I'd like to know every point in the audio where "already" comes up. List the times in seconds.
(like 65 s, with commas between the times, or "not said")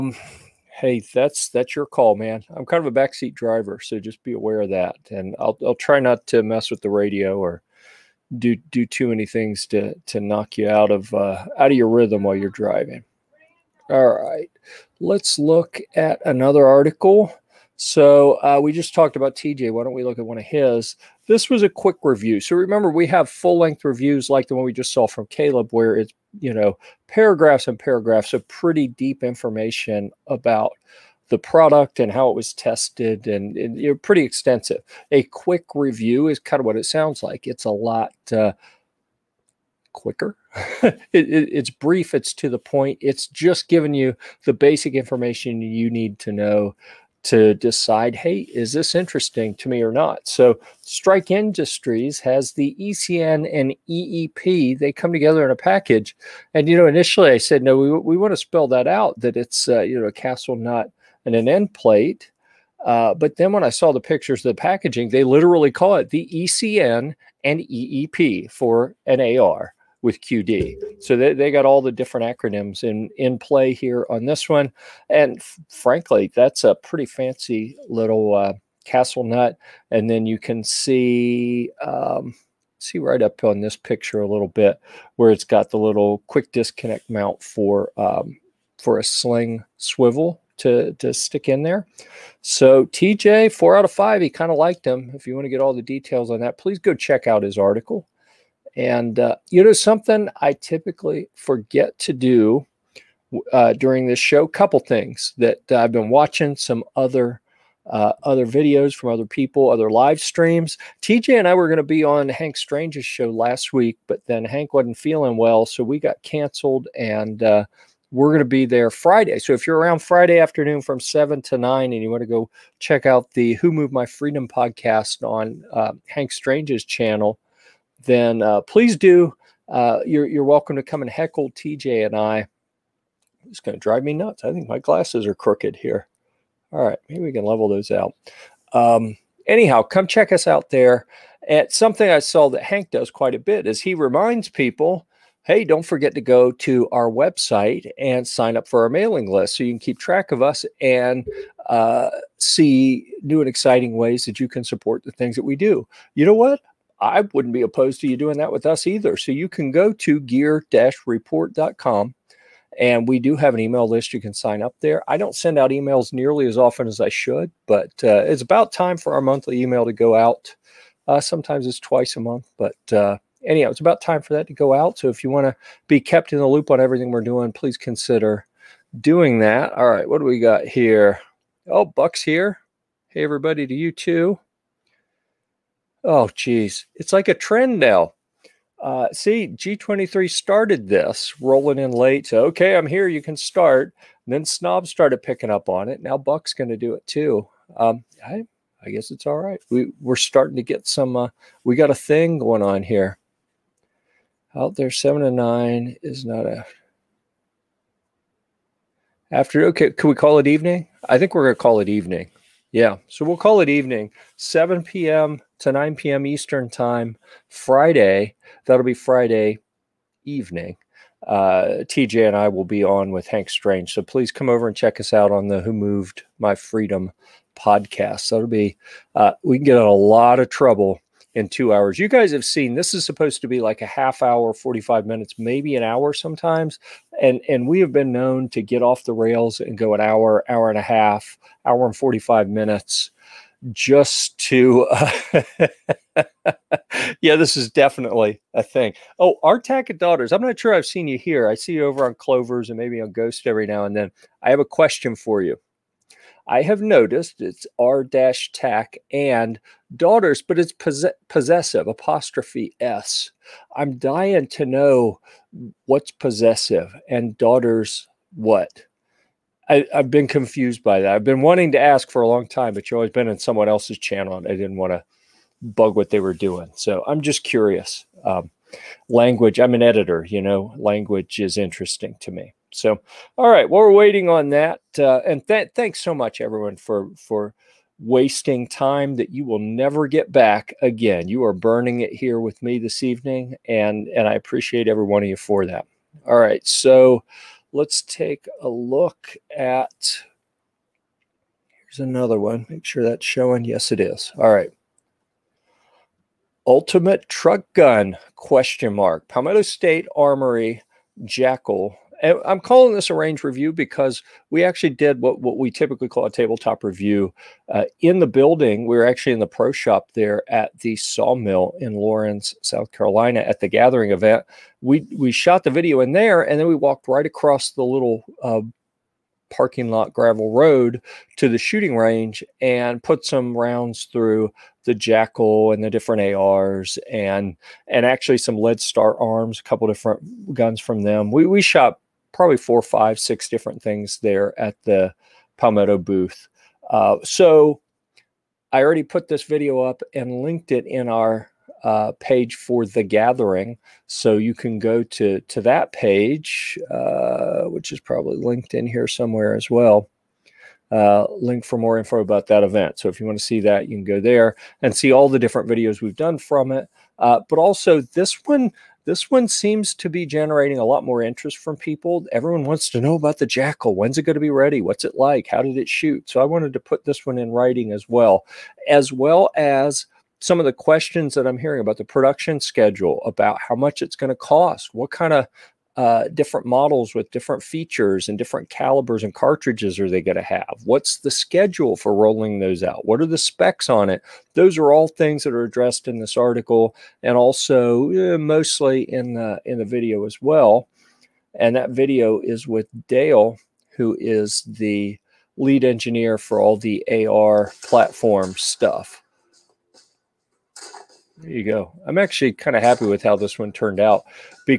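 348 s.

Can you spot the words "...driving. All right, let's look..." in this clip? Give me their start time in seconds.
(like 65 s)
12 s.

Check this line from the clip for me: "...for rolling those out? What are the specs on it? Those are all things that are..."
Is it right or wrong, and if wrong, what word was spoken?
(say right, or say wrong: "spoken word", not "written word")
right.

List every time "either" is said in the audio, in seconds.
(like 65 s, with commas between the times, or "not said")
158 s.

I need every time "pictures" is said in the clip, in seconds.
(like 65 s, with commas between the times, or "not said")
64 s, 83 s.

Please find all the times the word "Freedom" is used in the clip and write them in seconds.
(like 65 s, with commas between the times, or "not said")
124 s, 226 s.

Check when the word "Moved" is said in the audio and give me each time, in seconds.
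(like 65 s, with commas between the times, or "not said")
123 s, 225 s.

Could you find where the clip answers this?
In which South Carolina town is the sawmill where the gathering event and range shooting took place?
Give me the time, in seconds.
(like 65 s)
321 s.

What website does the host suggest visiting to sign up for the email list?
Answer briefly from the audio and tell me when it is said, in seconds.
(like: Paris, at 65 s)
gear-report.com, at 160 s.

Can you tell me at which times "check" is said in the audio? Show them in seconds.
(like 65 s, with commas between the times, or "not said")
96 s, 122 s, 140 s, 224 s.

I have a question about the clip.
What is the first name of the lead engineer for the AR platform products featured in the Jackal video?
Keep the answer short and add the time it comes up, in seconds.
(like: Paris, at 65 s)
Dale, at 403 s.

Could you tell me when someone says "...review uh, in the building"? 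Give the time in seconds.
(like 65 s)
316 s.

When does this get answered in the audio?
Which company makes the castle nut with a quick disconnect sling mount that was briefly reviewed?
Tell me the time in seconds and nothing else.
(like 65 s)
50 s.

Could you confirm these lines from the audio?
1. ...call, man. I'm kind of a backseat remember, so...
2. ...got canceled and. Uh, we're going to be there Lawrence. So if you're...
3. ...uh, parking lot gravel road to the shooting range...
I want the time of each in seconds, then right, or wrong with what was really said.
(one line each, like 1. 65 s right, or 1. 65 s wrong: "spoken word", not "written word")
1. 1 s wrong: "driver", not "remember"
2. 115 s wrong: "Friday", not "Lawrence"
3. 328 s right.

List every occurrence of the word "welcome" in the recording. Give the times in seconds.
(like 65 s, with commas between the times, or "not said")
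130 s.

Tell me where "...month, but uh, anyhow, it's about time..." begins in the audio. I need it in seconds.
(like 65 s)
172 s.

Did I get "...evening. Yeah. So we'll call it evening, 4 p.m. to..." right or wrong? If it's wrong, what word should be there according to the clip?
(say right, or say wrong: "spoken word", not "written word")
wrong: "7", not "4".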